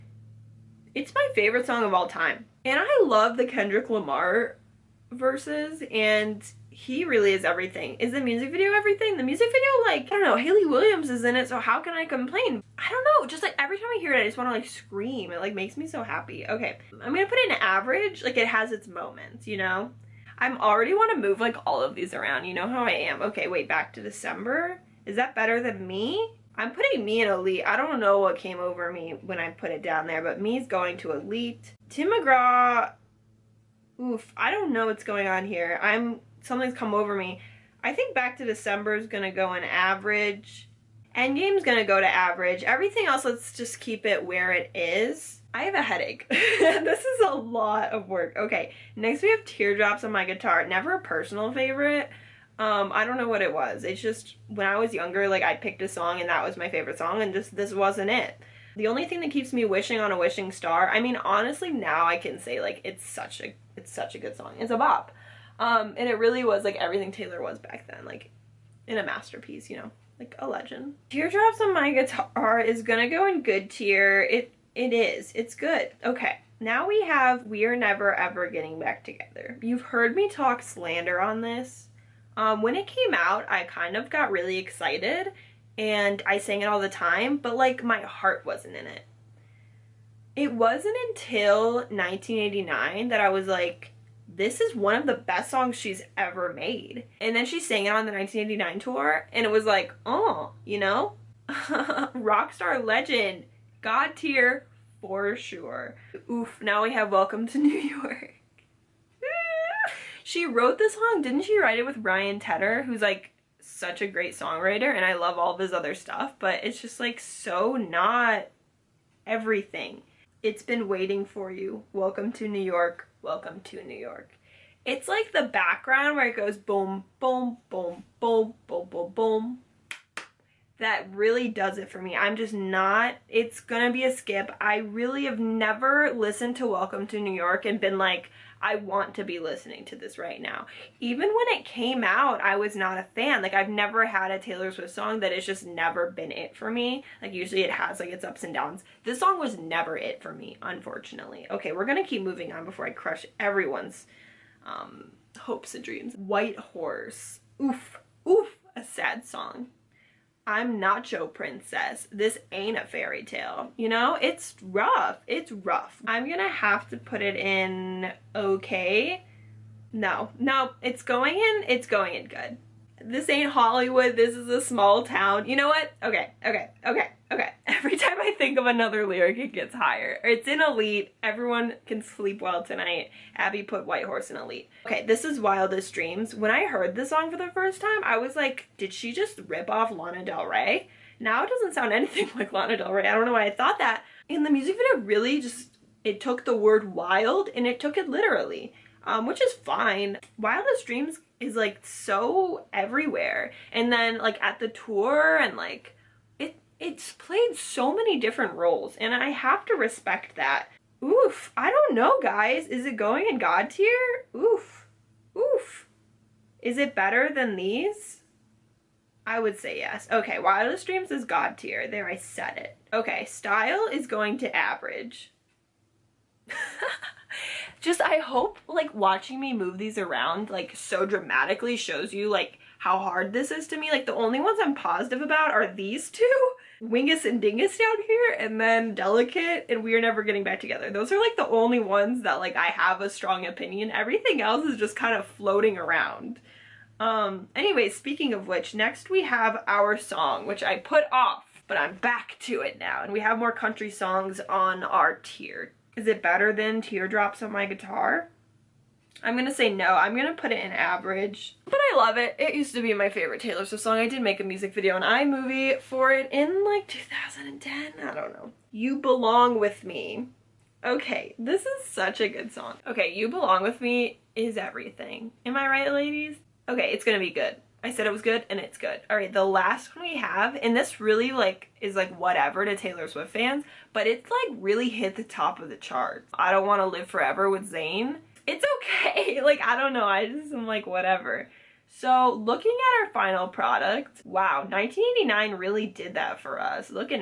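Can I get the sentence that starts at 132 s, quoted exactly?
I'm just not, it's gonna be a skip.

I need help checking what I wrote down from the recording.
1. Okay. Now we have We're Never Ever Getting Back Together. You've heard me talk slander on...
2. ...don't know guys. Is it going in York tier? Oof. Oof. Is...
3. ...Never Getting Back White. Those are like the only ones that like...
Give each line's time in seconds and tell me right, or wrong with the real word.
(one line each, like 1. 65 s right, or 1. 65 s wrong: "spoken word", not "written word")
1. 76 s right
2. 211 s wrong: "God", not "York"
3. 239 s wrong: "Together", not "White".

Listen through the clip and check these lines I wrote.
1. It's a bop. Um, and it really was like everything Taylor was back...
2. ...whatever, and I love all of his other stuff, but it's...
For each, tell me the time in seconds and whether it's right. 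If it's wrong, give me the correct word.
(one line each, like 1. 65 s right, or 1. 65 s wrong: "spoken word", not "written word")
1. 64 s right
2. 114 s wrong: "songwriter", not "whatever".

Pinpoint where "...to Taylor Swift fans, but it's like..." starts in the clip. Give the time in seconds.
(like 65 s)
282 s.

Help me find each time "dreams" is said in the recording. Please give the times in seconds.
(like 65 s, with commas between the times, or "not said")
155 s, 185 s, 200 s, 220 s.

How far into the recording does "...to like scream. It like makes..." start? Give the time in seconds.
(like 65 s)
14 s.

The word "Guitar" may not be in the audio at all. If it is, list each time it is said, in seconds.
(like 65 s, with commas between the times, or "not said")
50 s, 71 s, 257 s.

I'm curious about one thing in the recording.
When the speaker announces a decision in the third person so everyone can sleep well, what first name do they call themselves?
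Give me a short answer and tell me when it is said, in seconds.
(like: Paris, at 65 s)
Abby, at 183 s.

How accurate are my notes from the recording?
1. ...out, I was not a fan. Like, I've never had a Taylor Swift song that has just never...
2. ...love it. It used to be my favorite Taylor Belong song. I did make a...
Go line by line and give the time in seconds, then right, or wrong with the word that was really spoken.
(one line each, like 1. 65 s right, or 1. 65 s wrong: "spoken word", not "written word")
1. 142 s right
2. 261 s wrong: "Swift", not "Belong".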